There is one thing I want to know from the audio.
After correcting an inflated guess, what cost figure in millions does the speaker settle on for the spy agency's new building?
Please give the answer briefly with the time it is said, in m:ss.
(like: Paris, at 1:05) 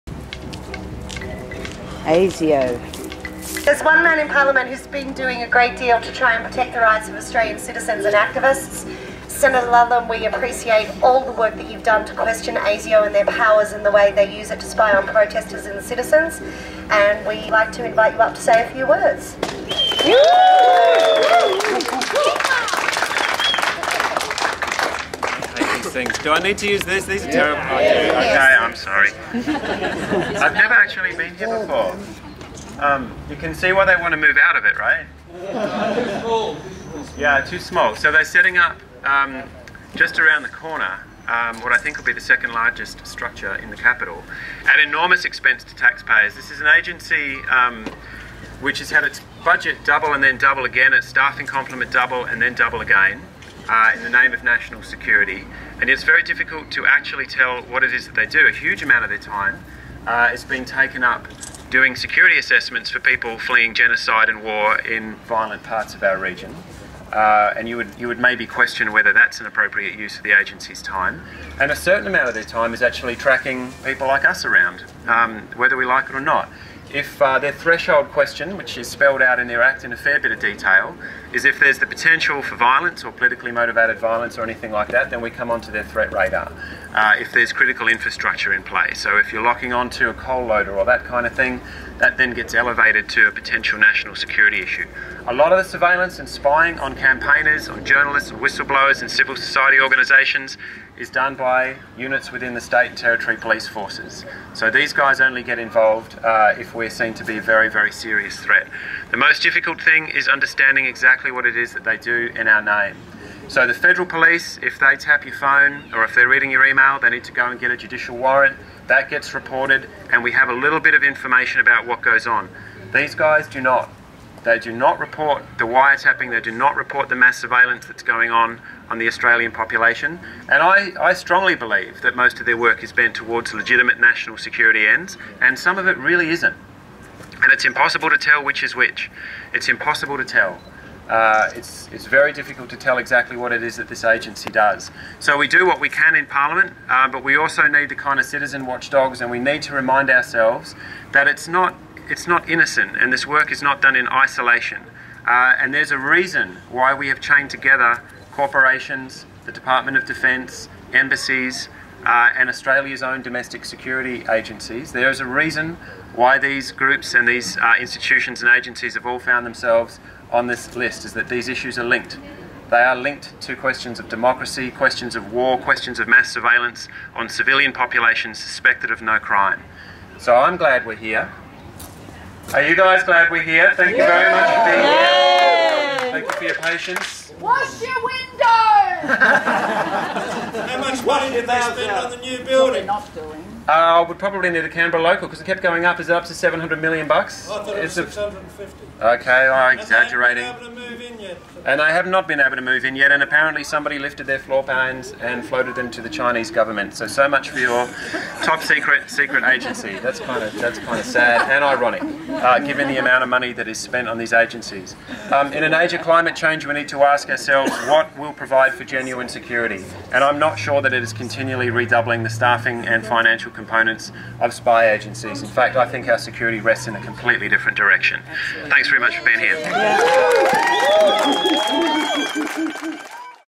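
650 million, at 3:18.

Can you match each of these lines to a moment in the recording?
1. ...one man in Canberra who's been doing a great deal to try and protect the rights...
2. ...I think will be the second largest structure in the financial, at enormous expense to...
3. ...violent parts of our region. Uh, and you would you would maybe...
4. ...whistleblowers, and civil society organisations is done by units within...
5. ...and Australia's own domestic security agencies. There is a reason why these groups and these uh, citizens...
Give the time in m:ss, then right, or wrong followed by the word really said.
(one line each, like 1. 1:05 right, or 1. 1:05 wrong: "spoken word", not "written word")
1. 0:03 wrong: "Parliament", not "Canberra"
2. 0:41 wrong: "capital", not "financial"
3. 1:05 right
4. 1:38 right
5. 2:42 wrong: "institutions", not "citizens".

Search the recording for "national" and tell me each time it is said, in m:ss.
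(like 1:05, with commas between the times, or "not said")
0:54, 1:33, 2:14.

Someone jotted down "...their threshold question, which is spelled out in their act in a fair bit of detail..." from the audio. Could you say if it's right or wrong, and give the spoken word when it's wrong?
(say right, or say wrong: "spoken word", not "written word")
right.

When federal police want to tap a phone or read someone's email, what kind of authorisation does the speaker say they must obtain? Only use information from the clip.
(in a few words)
Judicial warrant.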